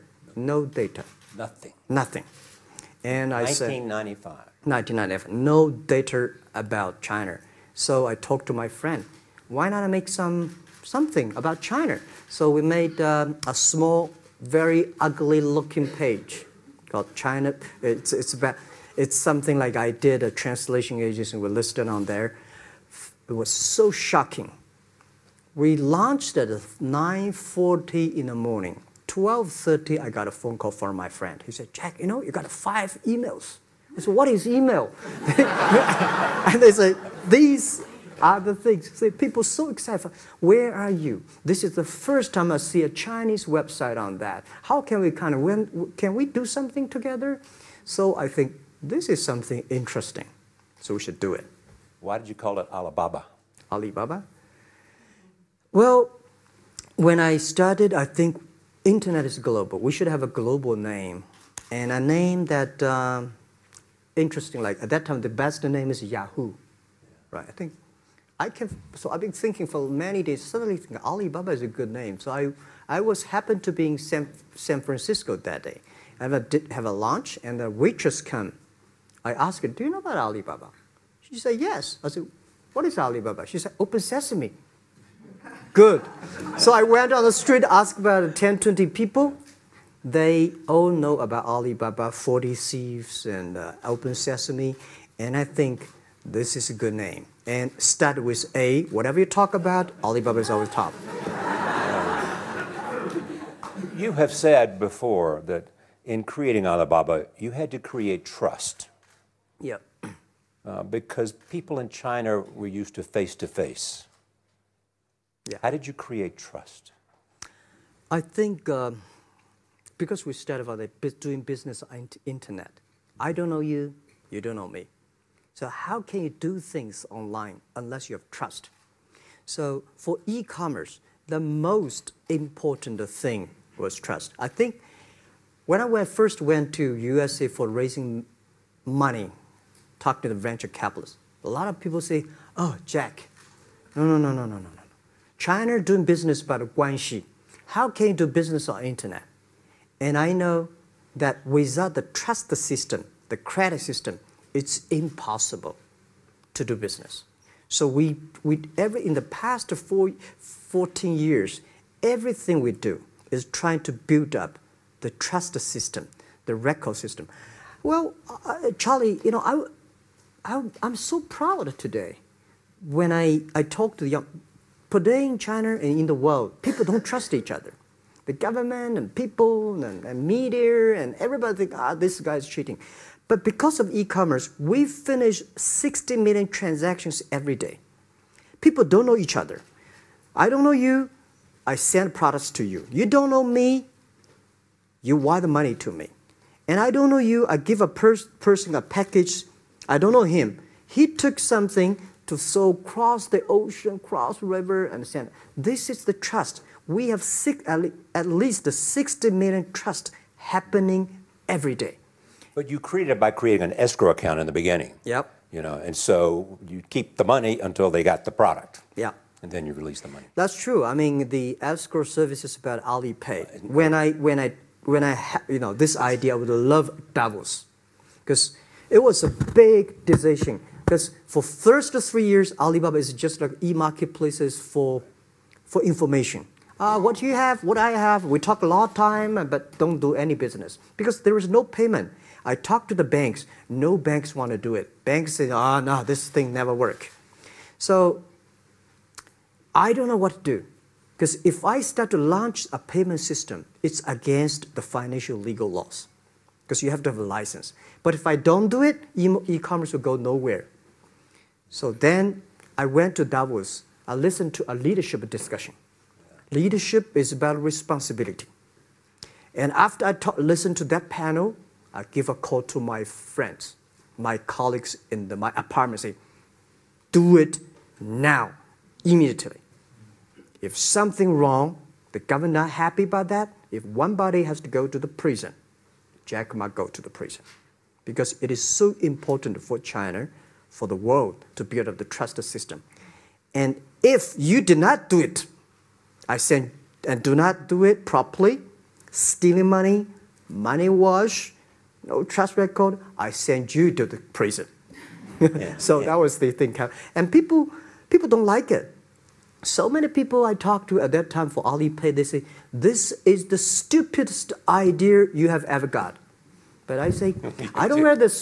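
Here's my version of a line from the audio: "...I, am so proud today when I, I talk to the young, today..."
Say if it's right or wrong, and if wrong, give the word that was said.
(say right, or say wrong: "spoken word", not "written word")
right.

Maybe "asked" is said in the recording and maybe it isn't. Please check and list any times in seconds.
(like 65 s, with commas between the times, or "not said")
79 s, 87 s.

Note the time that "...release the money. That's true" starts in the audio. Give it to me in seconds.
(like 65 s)
219 s.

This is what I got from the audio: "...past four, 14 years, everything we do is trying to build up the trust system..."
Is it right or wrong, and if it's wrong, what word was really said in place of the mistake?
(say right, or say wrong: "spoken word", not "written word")
right.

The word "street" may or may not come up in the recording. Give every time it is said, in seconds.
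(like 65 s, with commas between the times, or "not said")
87 s.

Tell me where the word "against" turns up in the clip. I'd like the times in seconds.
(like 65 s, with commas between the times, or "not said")
254 s.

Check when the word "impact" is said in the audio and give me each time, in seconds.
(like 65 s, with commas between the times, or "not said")
not said.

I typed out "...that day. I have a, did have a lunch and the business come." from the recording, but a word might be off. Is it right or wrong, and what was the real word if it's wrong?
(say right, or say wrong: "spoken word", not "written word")
wrong: "waitress", not "business".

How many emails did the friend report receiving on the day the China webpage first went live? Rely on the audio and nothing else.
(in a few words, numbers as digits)
5.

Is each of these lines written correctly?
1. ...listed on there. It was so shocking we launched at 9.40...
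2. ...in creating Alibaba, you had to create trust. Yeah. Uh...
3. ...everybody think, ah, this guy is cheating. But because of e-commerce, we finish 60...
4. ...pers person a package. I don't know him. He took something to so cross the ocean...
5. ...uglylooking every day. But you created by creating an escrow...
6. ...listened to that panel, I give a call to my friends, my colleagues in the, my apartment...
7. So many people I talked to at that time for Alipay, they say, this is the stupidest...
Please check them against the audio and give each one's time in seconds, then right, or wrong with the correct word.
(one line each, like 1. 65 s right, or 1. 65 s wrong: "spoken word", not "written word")
1. 21 s right
2. 106 s right
3. 181 s right
4. 197 s right
5. 210 s wrong: "happening", not "uglylooking"
6. 270 s right
7. 309 s right.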